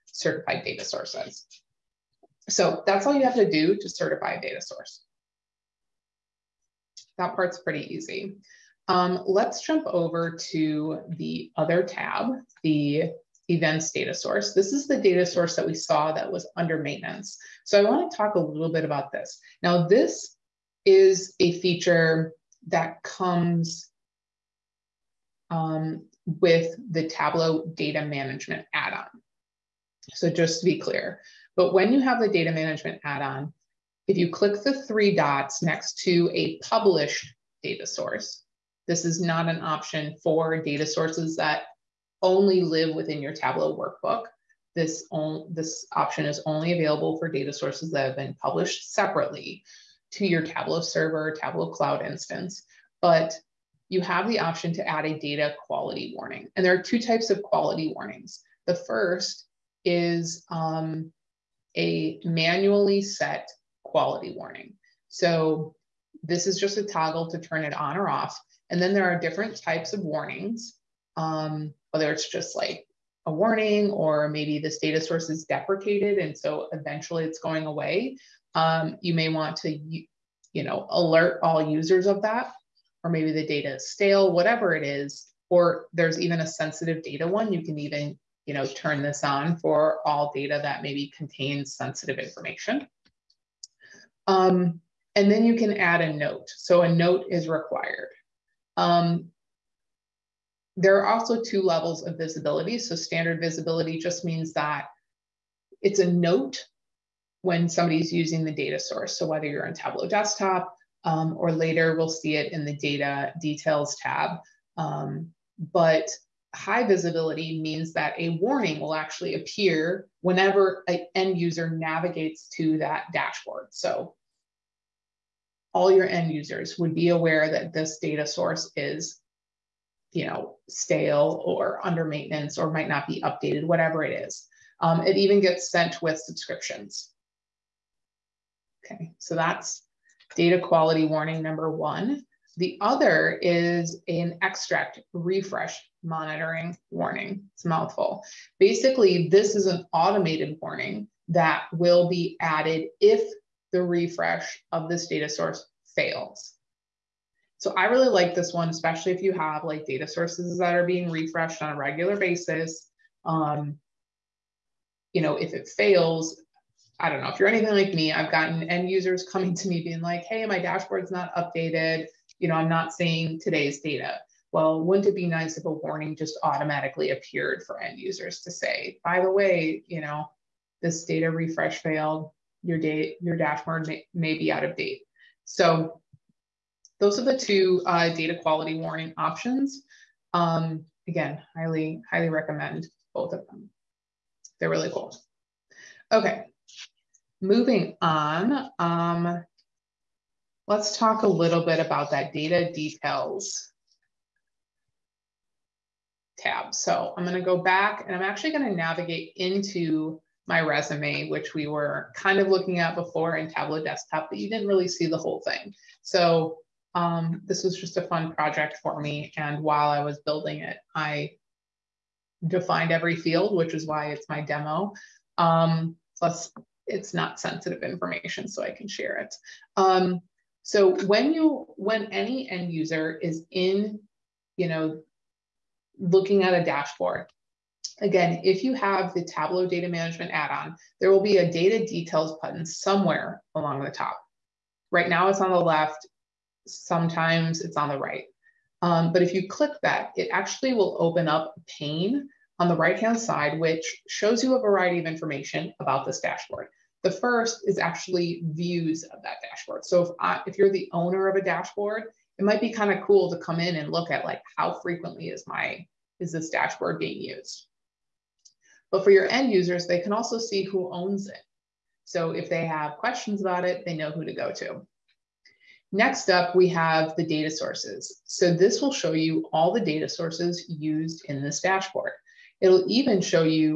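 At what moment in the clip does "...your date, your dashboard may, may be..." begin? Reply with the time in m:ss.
3:02.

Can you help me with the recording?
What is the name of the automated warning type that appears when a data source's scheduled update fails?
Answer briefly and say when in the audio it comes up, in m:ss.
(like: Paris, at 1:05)
Extract refresh monitoring warning, at 2:24.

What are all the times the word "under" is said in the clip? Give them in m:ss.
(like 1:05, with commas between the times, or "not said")
0:16, 2:11.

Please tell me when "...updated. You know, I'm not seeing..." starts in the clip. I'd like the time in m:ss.
2:51.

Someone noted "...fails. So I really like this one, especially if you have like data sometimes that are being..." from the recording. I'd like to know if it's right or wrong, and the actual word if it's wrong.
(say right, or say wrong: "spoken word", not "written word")
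wrong: "sources", not "sometimes".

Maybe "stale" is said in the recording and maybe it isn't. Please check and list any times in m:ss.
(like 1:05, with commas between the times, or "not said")
1:23, 2:10.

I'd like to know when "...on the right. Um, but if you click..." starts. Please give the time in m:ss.
4:07.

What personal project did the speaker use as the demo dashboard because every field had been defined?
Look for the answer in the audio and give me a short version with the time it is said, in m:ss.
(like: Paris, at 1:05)
Resume, at 3:30.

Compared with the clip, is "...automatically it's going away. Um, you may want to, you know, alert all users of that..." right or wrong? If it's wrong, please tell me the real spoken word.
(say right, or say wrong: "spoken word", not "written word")
wrong: "eventually", not "automatically".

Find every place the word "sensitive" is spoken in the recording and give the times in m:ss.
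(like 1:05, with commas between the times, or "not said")
1:26, 1:31, 3:47.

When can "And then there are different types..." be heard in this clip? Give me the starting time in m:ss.
1:08.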